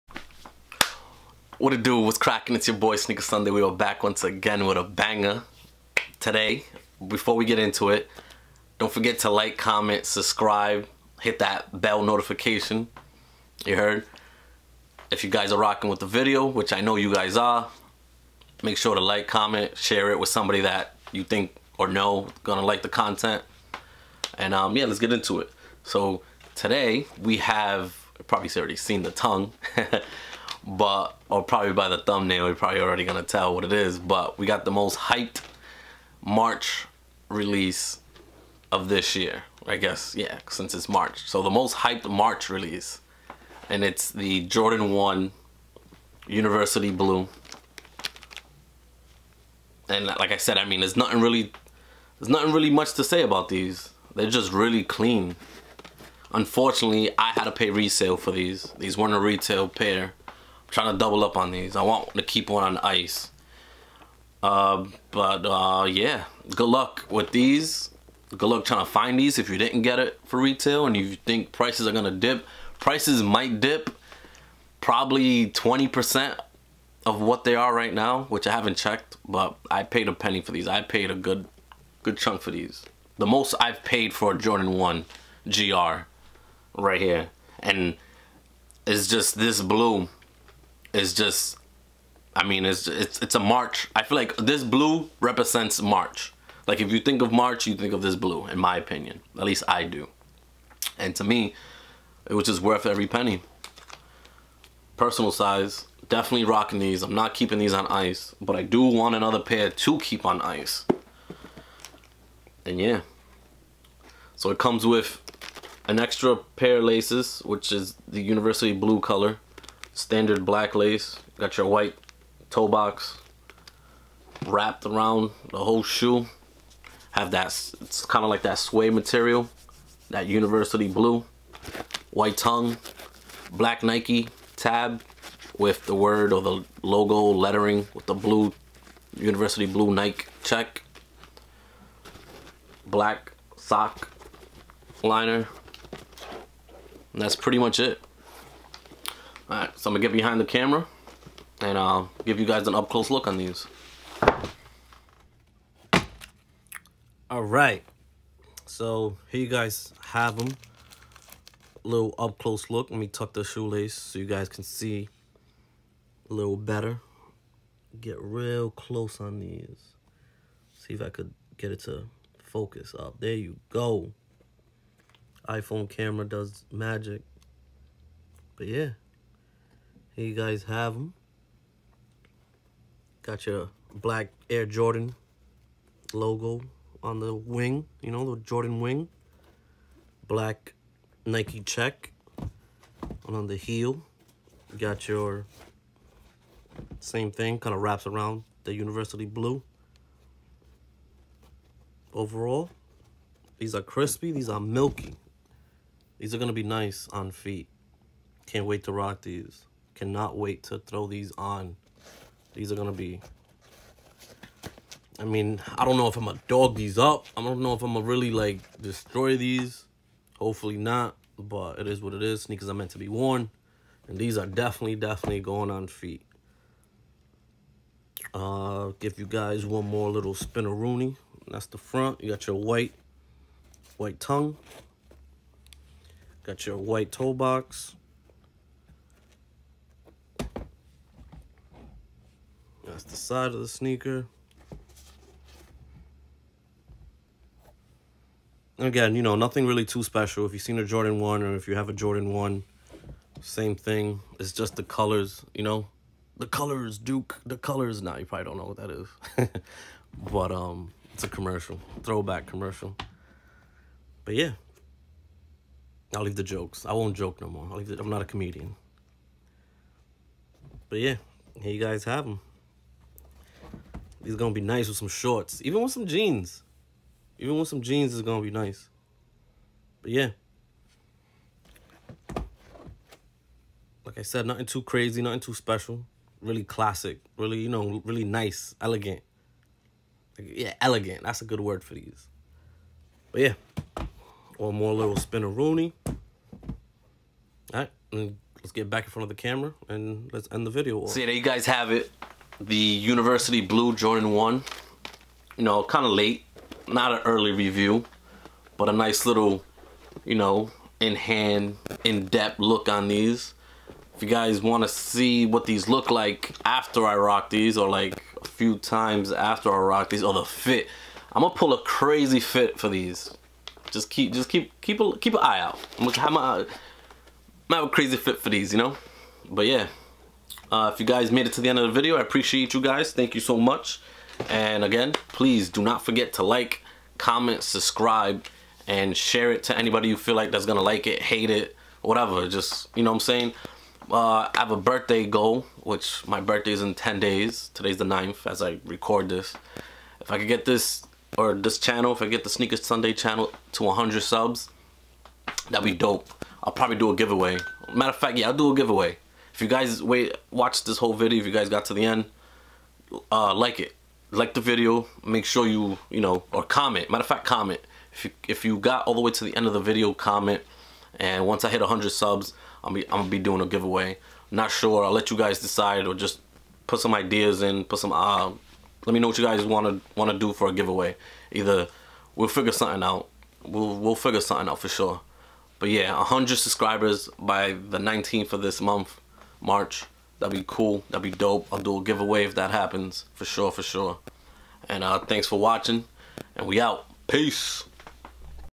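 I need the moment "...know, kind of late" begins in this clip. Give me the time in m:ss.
5:05.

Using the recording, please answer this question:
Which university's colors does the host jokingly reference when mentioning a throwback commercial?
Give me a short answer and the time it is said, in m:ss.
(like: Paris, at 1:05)
Duke, at 4:16.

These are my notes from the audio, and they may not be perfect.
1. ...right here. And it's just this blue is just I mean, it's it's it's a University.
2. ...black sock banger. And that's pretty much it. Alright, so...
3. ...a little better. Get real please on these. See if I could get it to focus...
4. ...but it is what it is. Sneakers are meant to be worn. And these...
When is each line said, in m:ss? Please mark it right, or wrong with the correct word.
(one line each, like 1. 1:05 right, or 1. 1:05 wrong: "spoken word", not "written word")
1. 1:26 wrong: "March", not "University"
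2. 2:22 wrong: "liner", not "banger"
3. 2:46 wrong: "close", not "please"
4. 3:41 right.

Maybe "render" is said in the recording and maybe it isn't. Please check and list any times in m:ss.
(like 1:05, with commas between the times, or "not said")
not said.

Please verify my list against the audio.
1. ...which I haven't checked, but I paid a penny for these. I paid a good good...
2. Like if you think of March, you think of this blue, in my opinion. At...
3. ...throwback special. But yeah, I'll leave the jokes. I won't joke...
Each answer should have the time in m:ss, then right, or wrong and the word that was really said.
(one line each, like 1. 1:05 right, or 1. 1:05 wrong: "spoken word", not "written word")
1. 1:18 right
2. 1:36 right
3. 4:22 wrong: "commercial", not "special".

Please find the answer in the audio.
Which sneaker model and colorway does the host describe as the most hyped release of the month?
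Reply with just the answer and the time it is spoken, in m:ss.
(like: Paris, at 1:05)
Jordan 1 University Blue, at 0:44.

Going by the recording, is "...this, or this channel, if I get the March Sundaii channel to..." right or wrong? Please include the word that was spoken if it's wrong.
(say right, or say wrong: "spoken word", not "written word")
wrong: "Sneakers", not "March".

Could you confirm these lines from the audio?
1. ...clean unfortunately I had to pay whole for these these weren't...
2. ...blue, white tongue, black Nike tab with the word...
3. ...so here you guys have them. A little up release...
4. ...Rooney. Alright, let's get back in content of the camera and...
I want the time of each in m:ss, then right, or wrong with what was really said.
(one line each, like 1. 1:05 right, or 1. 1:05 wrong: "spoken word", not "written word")
1. 0:54 wrong: "resale", not "whole"
2. 2:10 right
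3. 2:38 wrong: "close", not "release"
4. 4:55 wrong: "front", not "content".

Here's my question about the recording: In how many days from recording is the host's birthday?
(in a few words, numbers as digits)
10 days.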